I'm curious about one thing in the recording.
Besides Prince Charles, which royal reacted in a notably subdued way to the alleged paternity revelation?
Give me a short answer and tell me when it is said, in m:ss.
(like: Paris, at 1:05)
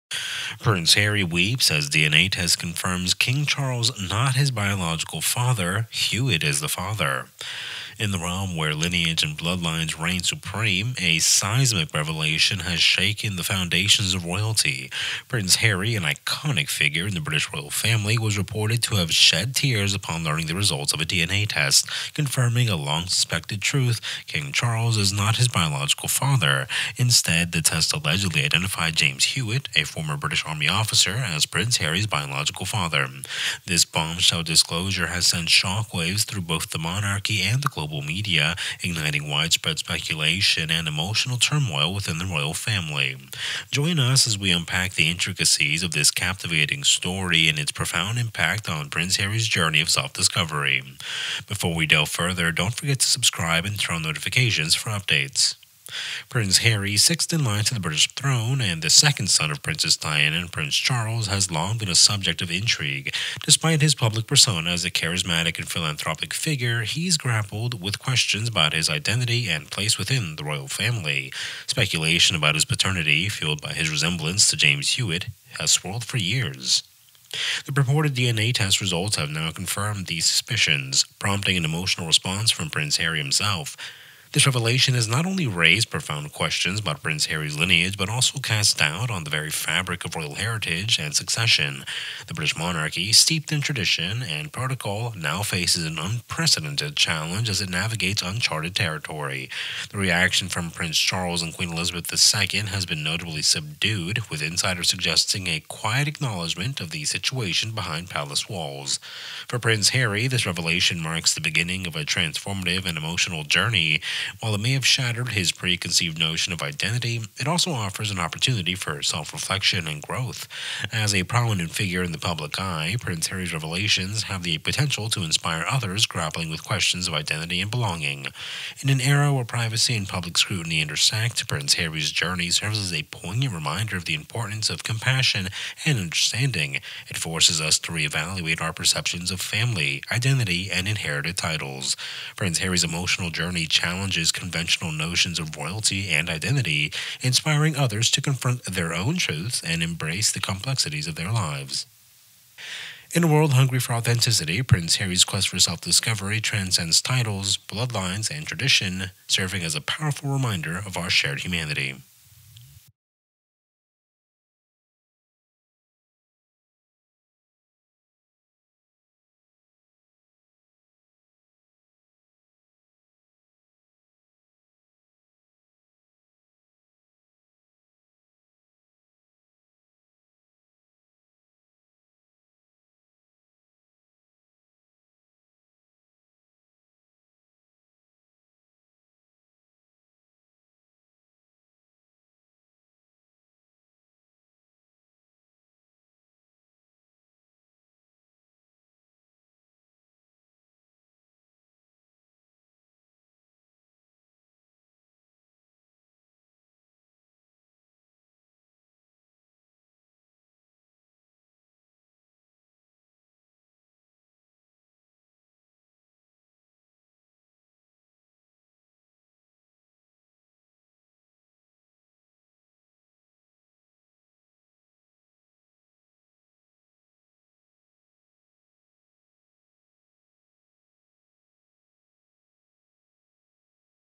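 Queen Elizabeth II, at 1:41.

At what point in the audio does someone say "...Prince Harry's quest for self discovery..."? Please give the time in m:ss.
2:34.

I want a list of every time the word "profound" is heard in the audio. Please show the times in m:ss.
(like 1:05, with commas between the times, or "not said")
0:47, 1:25.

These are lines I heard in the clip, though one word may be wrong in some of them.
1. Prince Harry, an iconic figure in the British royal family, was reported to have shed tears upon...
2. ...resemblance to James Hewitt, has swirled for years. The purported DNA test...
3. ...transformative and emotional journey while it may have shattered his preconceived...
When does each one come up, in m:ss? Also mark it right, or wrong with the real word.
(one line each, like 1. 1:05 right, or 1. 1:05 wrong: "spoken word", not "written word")
1. 0:15 right
2. 1:13 right
3. 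1:52 right.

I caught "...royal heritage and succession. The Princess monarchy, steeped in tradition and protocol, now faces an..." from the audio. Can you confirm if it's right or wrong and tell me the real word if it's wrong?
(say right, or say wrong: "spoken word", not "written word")
wrong: "British", not "Princess".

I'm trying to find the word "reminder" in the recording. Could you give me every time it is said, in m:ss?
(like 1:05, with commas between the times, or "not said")
2:13, 2:40.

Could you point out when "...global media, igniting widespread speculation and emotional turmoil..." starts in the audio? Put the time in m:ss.
0:37.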